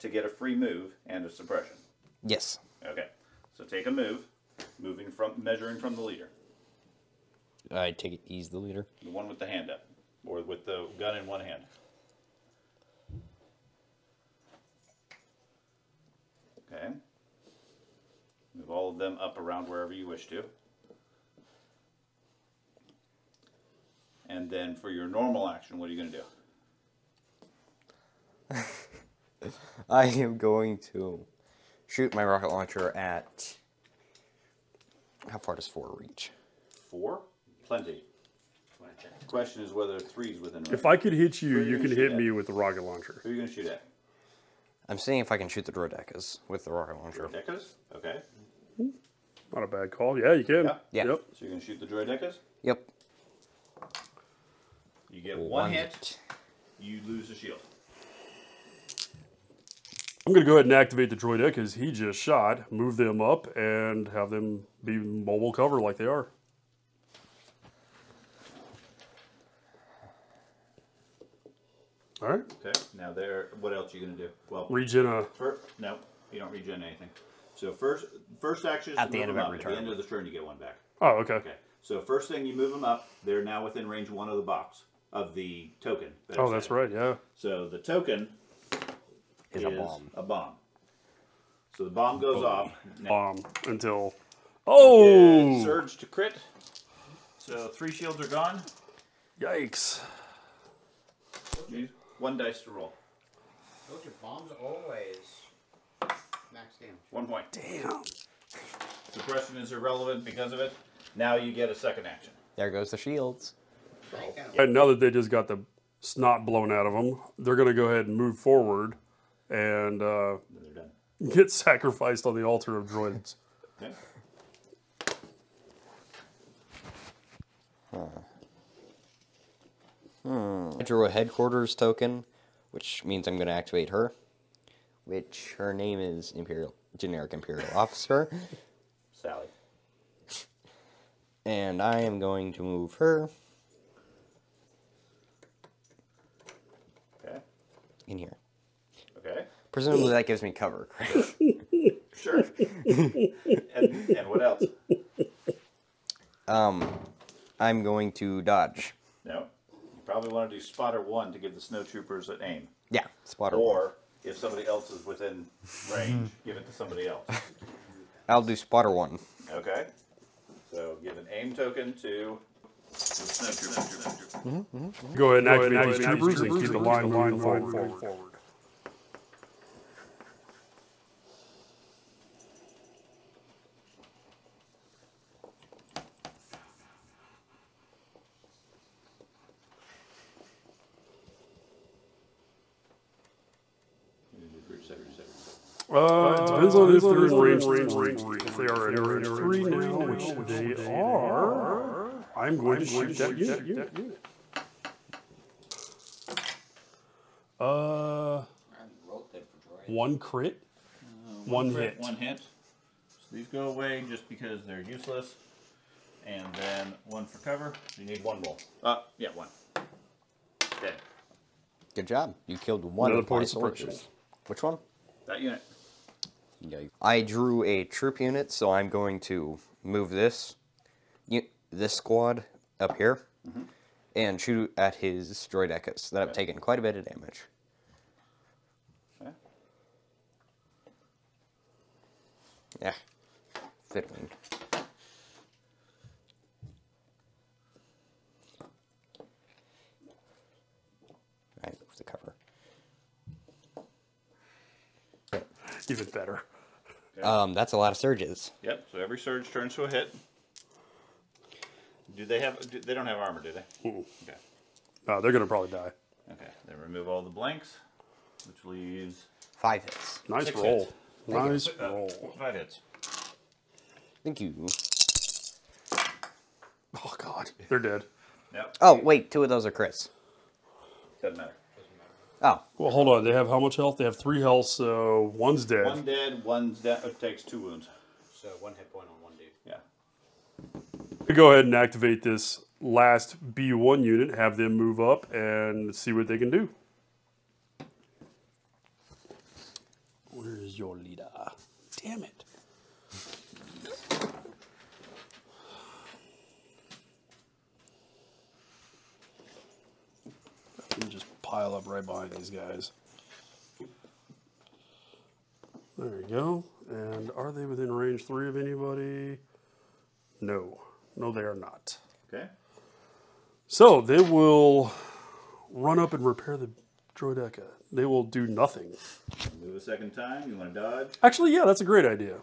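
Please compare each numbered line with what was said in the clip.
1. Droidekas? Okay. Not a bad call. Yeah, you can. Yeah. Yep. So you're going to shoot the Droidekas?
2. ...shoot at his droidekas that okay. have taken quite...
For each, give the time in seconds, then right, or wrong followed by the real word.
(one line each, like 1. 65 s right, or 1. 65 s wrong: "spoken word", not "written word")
1. 47 s right
2. 234 s right.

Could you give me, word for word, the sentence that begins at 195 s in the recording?
Uh, it depends on if they're in range three.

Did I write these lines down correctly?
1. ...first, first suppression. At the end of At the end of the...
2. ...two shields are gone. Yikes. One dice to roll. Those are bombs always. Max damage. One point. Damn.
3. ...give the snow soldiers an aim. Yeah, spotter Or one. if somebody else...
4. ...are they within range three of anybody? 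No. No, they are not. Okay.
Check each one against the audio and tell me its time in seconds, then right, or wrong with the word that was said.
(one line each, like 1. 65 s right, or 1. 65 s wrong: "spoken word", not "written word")
1. 77 s wrong: "action", not "suppression"
2. 97 s wrong: "three", not "two"
3. 161 s wrong: "troopers", not "soldiers"
4. 317 s right.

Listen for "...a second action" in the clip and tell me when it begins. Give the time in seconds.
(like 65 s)
111 s.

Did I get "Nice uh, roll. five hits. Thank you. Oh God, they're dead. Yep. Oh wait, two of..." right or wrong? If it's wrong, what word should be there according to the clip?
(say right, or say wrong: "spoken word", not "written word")
right.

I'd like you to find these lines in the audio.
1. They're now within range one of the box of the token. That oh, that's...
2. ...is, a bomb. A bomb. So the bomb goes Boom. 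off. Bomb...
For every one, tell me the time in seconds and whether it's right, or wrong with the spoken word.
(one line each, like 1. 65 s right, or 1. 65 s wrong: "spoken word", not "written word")
1. 83 s right
2. 89 s right.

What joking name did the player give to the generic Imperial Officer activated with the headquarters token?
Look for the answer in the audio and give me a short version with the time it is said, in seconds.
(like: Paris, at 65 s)
Sally, at 139 s.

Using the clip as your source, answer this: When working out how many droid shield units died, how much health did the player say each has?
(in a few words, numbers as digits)
3.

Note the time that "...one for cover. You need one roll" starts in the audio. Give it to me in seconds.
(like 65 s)
217 s.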